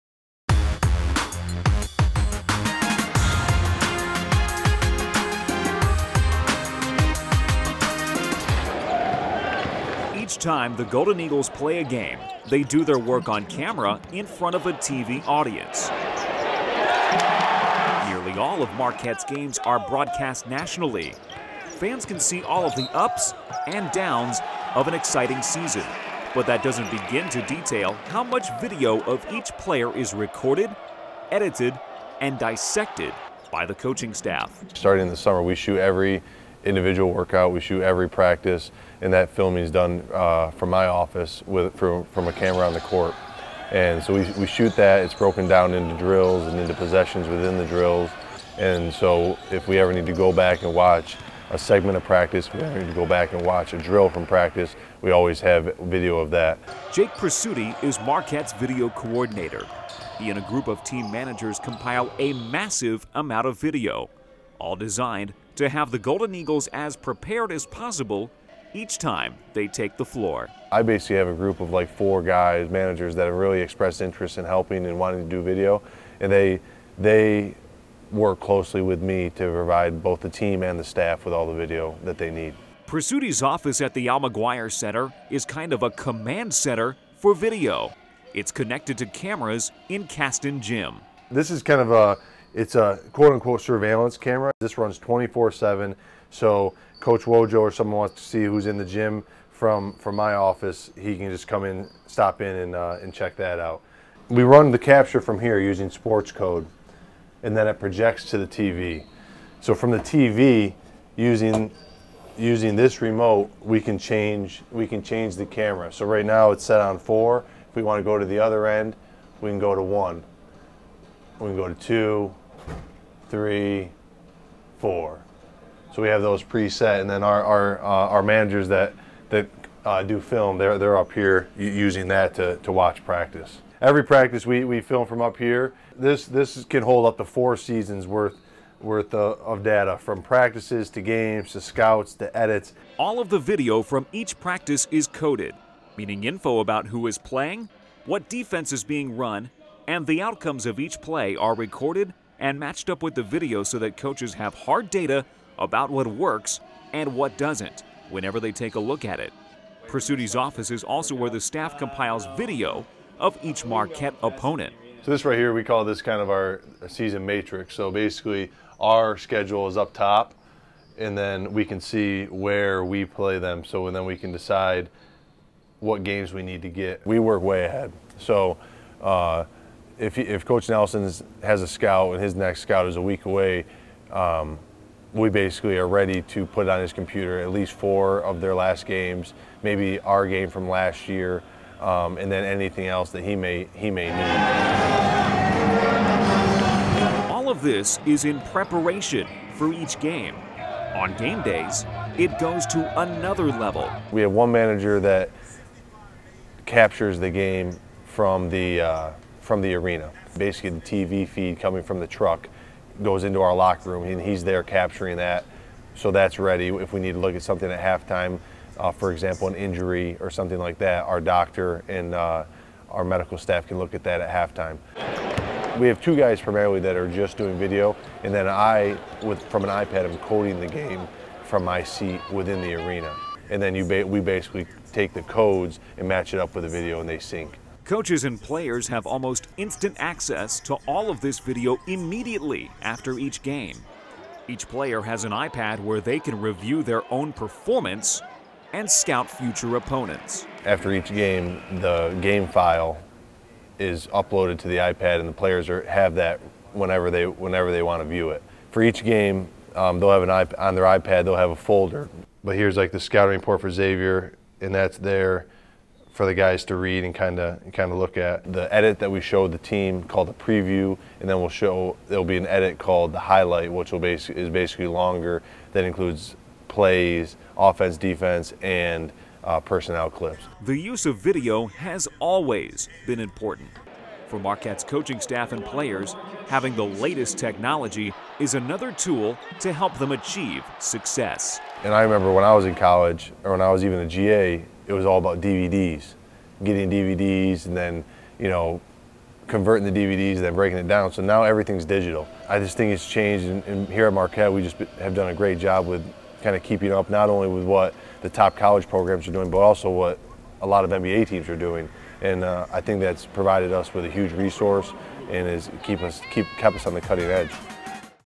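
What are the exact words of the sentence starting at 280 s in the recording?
The use of video has always been important.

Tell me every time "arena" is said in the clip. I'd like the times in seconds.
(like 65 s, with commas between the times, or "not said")
209 s, 232 s.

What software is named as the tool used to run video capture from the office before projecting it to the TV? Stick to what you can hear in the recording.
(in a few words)
Sports code.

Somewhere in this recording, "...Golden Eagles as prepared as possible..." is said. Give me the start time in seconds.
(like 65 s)
65 s.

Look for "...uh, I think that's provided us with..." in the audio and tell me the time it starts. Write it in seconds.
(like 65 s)
312 s.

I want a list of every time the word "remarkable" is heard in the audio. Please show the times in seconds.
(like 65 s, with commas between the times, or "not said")
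not said.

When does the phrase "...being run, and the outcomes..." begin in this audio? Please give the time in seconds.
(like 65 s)
148 s.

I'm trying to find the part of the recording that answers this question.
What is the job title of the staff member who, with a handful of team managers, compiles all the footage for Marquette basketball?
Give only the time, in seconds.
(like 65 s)
58 s.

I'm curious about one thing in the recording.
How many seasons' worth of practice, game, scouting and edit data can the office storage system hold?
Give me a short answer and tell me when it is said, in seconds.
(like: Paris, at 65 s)
4, at 137 s.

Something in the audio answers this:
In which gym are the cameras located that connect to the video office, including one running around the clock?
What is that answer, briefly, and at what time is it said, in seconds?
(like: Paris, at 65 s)
Caston Gym, at 90 s.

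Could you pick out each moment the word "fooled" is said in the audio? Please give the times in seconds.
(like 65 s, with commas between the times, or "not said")
not said.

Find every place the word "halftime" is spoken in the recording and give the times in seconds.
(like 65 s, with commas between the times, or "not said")
217 s, 224 s.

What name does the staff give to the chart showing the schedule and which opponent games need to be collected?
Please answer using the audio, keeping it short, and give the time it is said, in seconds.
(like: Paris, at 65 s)
Season matrix, at 166 s.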